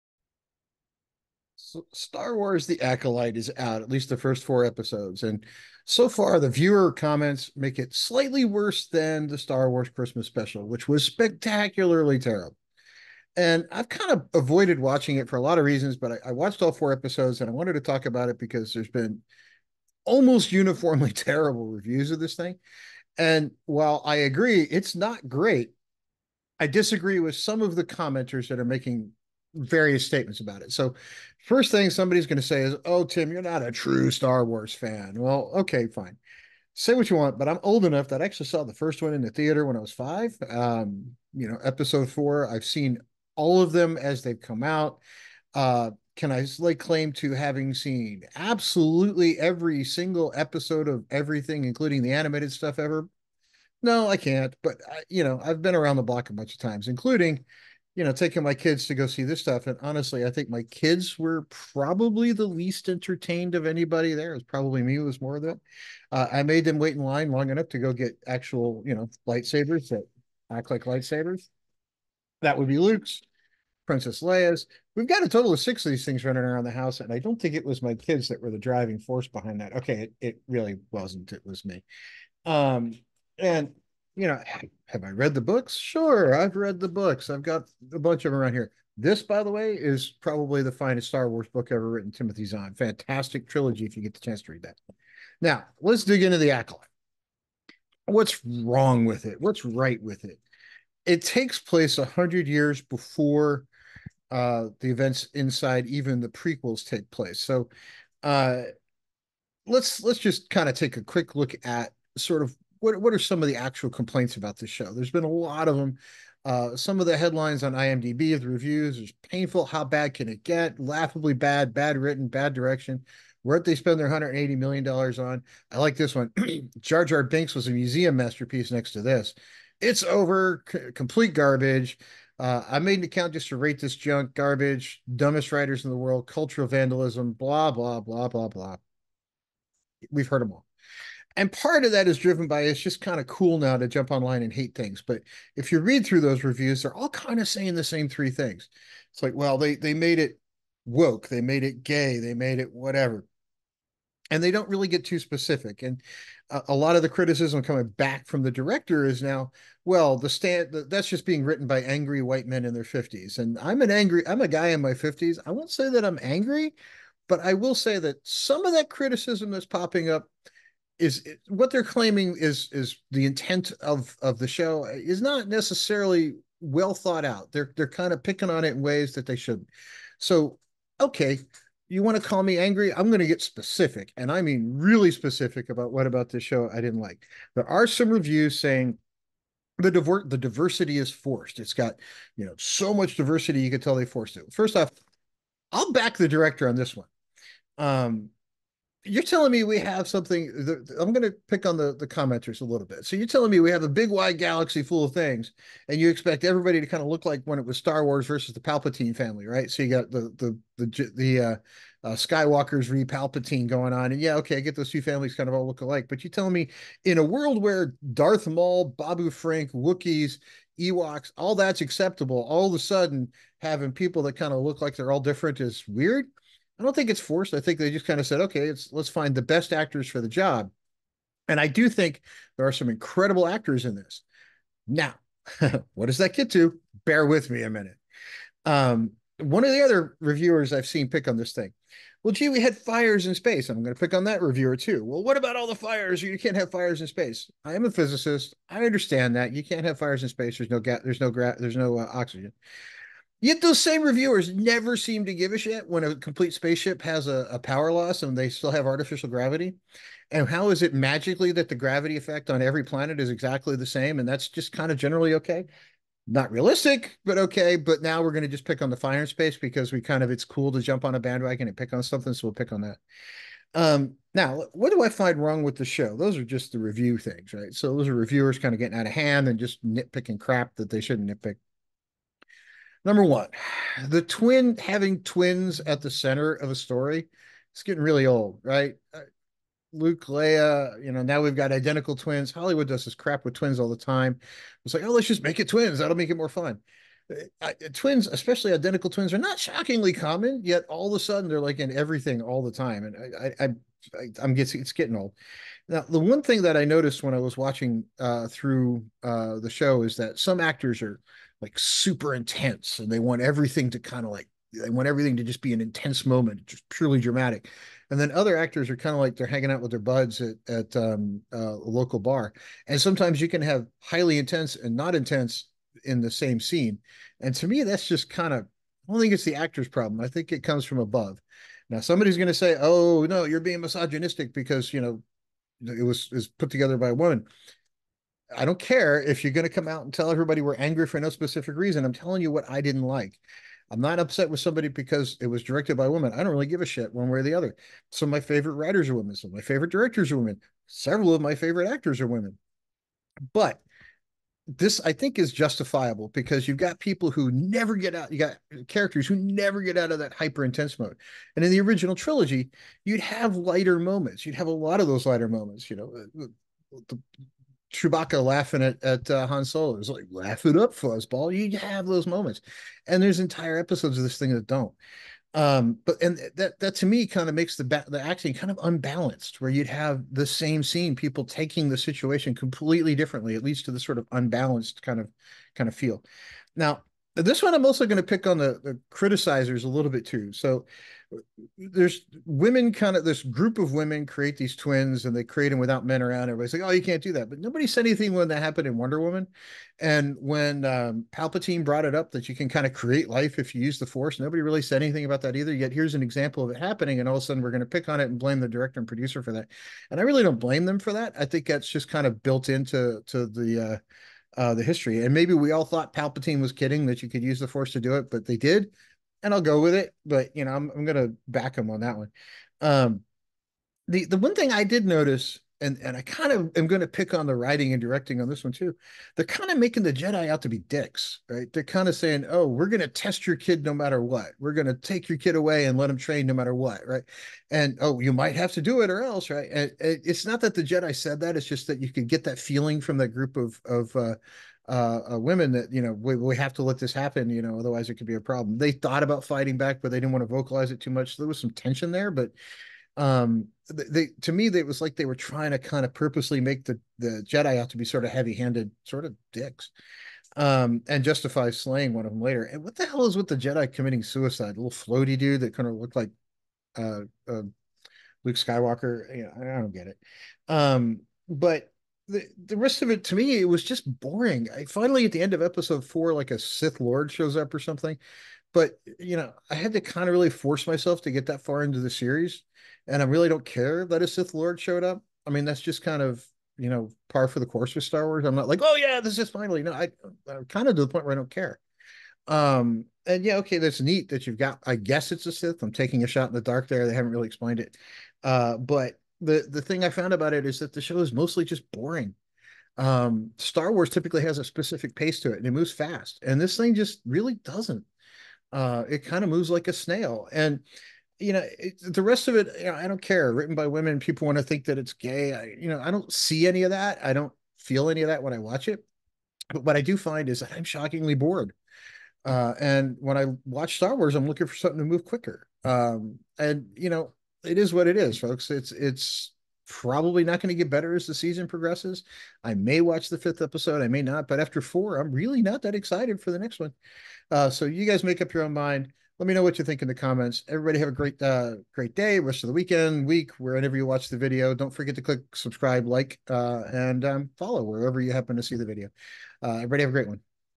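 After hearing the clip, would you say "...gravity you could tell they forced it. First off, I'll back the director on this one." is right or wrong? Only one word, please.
wrong.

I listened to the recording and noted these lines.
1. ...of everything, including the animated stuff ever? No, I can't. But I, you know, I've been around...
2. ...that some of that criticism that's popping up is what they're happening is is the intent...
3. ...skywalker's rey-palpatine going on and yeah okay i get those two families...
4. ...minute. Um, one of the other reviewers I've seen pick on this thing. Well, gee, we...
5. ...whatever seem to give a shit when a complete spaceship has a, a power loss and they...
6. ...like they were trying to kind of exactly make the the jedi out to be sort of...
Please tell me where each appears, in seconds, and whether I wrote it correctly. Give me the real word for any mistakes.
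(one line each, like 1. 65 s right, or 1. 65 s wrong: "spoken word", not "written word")
1. 50 s right
2. 167 s wrong: "claiming", not "happening"
3. 212 s right
4. 237 s right
5. 254 s wrong: "never", not "whatever"
6. 455 s wrong: "purposely", not "exactly".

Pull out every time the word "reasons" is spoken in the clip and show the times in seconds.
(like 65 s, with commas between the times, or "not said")
15 s, 341 s.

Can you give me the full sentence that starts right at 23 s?
And while I agree it's not great, I disagree with some of the commenters that are making various statements about it.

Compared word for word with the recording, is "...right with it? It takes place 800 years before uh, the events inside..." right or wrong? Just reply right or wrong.
wrong.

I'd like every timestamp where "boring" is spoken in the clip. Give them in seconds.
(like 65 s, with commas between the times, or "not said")
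474 s, 501 s.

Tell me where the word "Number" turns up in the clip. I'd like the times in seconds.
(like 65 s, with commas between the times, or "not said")
283 s.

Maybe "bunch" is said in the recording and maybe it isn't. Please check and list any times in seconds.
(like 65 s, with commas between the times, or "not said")
56 s, 87 s.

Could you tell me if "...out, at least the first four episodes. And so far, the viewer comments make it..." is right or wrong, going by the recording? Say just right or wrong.
right.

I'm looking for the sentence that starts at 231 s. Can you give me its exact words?
And I do think there are some incredible actors in this.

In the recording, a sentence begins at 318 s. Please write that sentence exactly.
And then other actors are kind of like they're hanging out with their buds at, at um, uh, a local bar.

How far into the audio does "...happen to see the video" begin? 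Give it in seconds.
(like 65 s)
548 s.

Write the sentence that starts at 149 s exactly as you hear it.
It's like, well, they they made it woke, they made it gay, they made it whatever.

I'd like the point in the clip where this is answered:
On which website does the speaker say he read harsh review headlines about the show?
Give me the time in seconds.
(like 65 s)
117 s.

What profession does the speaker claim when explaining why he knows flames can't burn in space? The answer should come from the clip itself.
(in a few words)
Physicist.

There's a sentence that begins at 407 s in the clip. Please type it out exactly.
And all of a sudden we're going to pick on it and blame the director and producer for that.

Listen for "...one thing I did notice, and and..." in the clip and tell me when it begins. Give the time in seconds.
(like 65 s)
424 s.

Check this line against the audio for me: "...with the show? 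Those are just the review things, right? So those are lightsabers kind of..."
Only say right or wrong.
wrong.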